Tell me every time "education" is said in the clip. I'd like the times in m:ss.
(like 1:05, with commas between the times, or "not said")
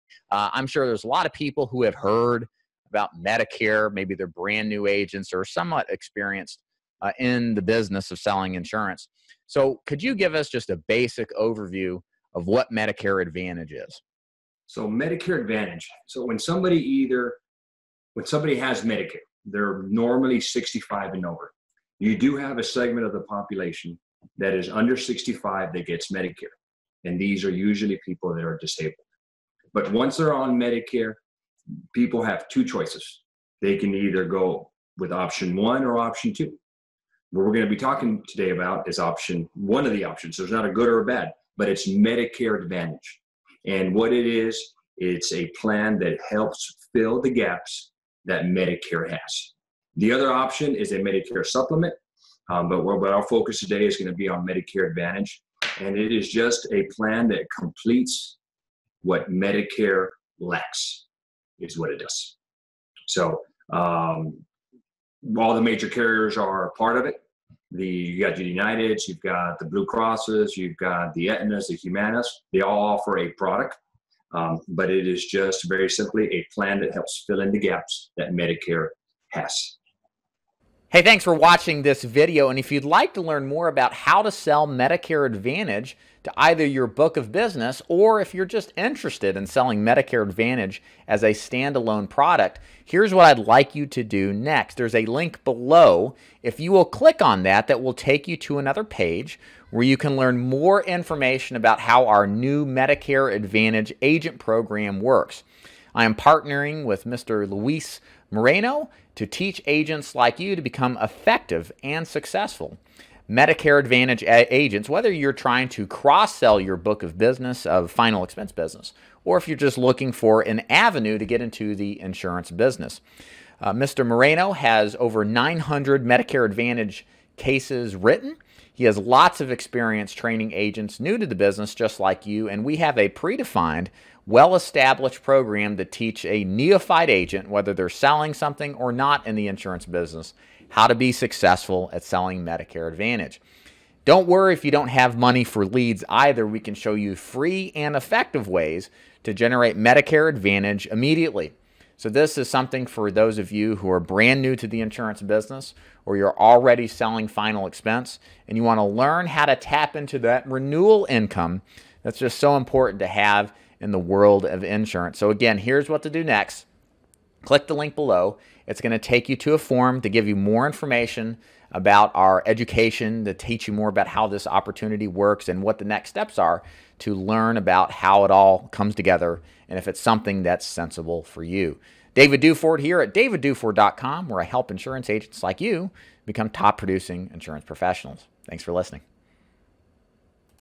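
2:52.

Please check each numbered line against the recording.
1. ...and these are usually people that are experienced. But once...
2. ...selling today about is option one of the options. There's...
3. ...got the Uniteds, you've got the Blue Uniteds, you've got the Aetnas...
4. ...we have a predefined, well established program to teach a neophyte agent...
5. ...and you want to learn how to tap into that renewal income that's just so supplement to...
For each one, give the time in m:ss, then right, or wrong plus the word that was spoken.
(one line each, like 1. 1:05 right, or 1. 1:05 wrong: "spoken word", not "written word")
1. 0:27 wrong: "disabled", not "experienced"
2. 0:37 wrong: "talking", not "selling"
3. 1:08 wrong: "Crosses", not "Uniteds"
4. 2:12 right
5. 2:38 wrong: "important", not "supplement".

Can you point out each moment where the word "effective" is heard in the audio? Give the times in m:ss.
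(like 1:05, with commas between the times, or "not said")
1:51, 2:27.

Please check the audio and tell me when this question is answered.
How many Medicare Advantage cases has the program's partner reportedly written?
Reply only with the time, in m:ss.
2:05.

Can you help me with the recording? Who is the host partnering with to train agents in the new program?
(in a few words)
Luis Moreno.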